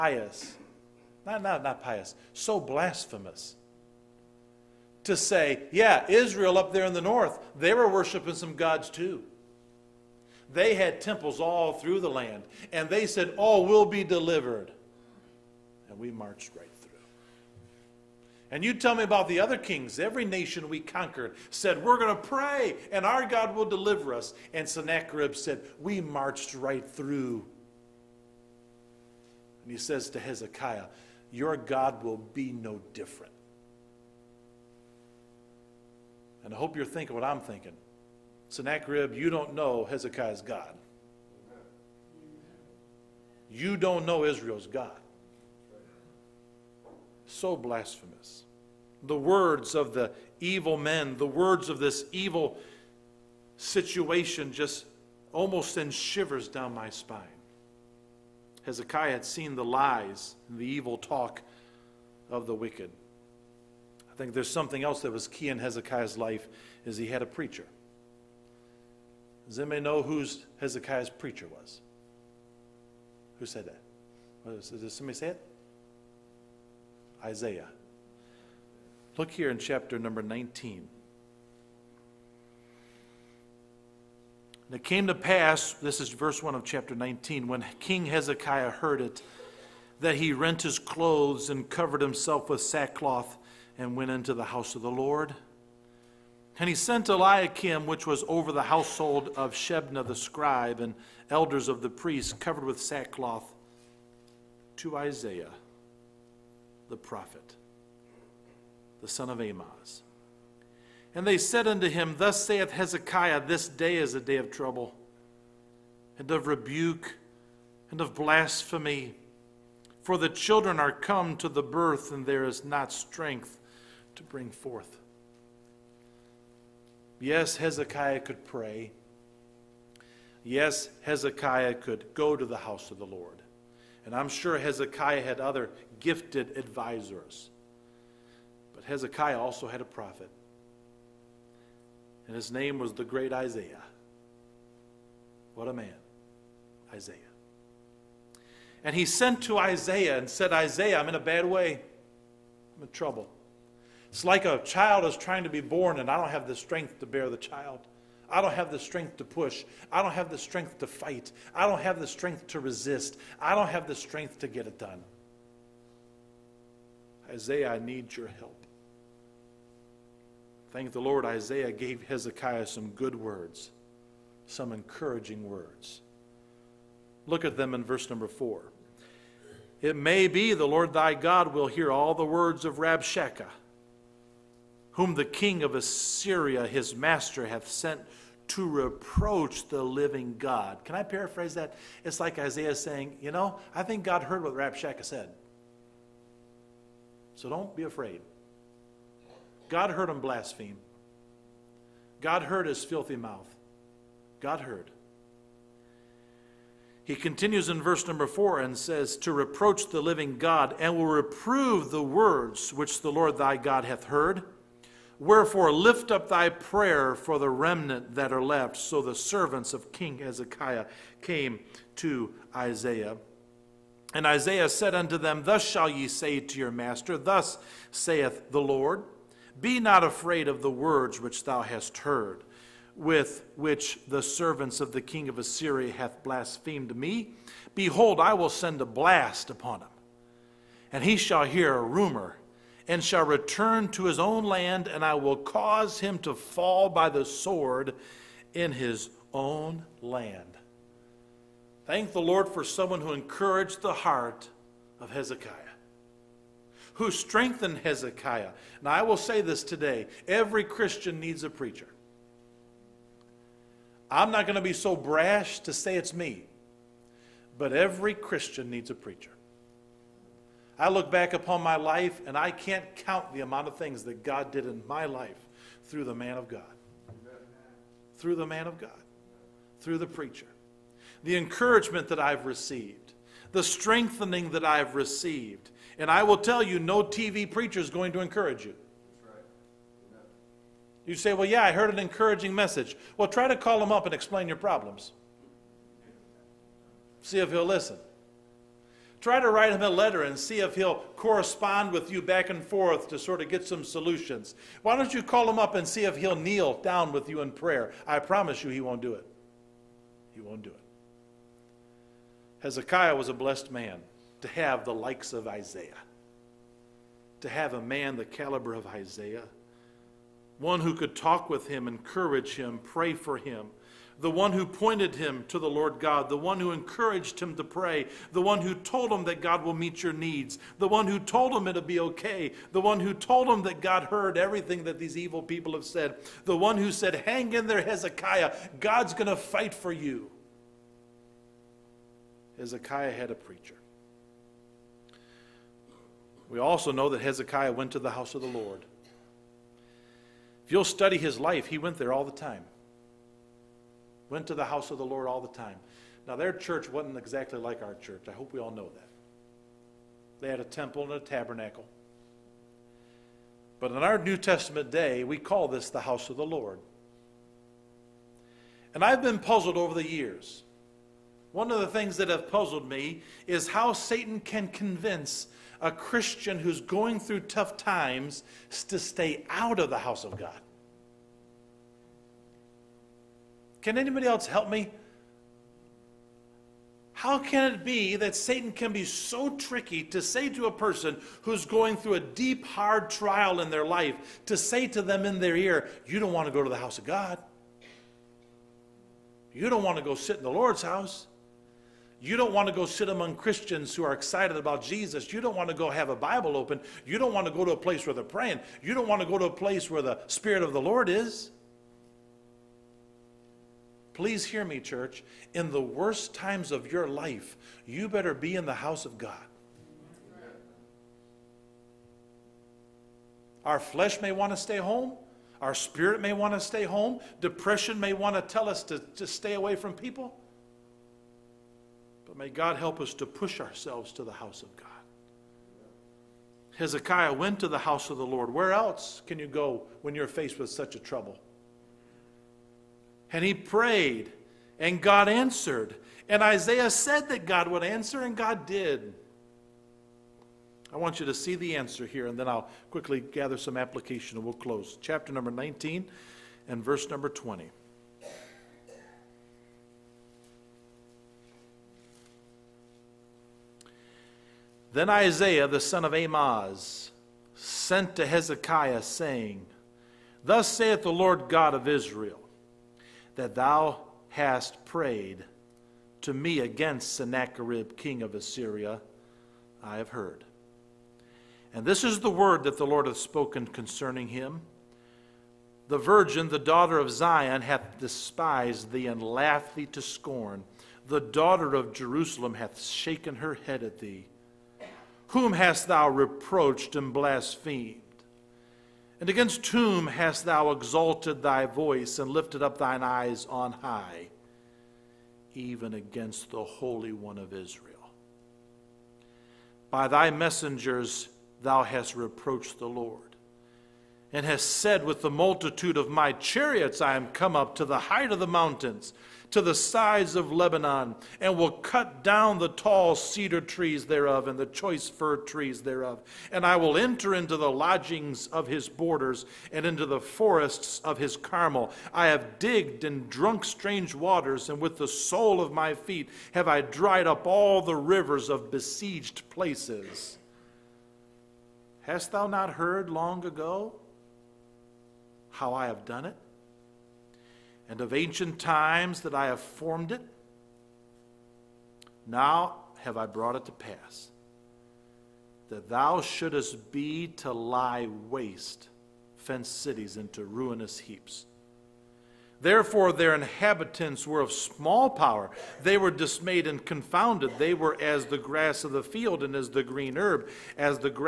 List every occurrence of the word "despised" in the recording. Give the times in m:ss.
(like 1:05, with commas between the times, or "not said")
8:07.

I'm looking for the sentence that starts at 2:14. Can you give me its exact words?
And I'm sure Hezekiah had other gifted advisors.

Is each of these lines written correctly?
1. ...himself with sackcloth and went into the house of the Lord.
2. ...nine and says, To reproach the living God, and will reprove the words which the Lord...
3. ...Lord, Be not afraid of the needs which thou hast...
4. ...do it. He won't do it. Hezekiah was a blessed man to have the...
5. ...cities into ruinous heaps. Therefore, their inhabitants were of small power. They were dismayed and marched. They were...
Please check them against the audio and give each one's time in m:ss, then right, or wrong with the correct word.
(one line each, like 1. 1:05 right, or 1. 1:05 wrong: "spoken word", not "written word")
1. 1:32 right
2. 3:28 wrong: "four", not "nine"
3. 3:48 wrong: "words", not "needs"
4. 5:09 right
5. 9:19 wrong: "confounded", not "marched".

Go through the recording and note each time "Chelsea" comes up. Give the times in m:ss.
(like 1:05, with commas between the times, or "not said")
not said.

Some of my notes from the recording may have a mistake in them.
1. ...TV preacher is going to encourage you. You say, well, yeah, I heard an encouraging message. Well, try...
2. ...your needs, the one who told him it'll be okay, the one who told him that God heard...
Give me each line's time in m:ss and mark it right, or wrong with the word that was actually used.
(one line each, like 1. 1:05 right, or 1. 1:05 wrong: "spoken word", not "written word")
1. 4:47 right
2. 5:30 right.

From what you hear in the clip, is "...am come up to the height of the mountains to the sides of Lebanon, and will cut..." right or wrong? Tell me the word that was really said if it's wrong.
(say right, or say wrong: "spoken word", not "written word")
right.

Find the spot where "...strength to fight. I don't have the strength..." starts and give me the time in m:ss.
2:40.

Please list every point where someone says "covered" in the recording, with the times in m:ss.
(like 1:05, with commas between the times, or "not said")
1:31, 1:42.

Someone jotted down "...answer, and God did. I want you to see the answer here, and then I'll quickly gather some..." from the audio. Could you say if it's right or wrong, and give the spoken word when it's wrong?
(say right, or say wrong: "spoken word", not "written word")
right.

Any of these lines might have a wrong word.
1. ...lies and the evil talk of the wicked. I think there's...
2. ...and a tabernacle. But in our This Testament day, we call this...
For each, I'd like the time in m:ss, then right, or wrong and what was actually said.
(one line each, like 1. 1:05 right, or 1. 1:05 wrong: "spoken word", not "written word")
1. 0:59 right
2. 6:01 wrong: "New", not "This".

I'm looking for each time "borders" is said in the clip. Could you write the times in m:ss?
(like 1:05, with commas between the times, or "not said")
8:48.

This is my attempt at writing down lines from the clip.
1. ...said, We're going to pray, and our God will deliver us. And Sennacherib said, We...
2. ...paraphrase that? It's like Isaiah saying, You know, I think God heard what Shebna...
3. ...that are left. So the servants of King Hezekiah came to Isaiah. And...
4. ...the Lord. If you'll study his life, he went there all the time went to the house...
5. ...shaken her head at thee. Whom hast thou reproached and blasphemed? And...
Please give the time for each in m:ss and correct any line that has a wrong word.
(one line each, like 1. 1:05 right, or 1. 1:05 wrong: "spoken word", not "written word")
1. 0:21 right
2. 3:11 wrong: "Rabshakeh", not "Shebna"
3. 3:38 right
4. 5:48 right
5. 8:12 right.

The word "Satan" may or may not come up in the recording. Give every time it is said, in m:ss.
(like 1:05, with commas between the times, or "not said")
6:13, 6:28.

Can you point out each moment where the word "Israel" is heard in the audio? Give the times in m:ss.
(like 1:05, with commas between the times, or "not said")
0:06, 0:44, 7:51, 8:27.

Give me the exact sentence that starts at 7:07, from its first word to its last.
Depression may want to tell us to, to stay away from people.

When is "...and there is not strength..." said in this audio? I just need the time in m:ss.
2:02.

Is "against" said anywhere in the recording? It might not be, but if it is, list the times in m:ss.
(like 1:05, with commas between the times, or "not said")
7:56, 8:19, 8:25.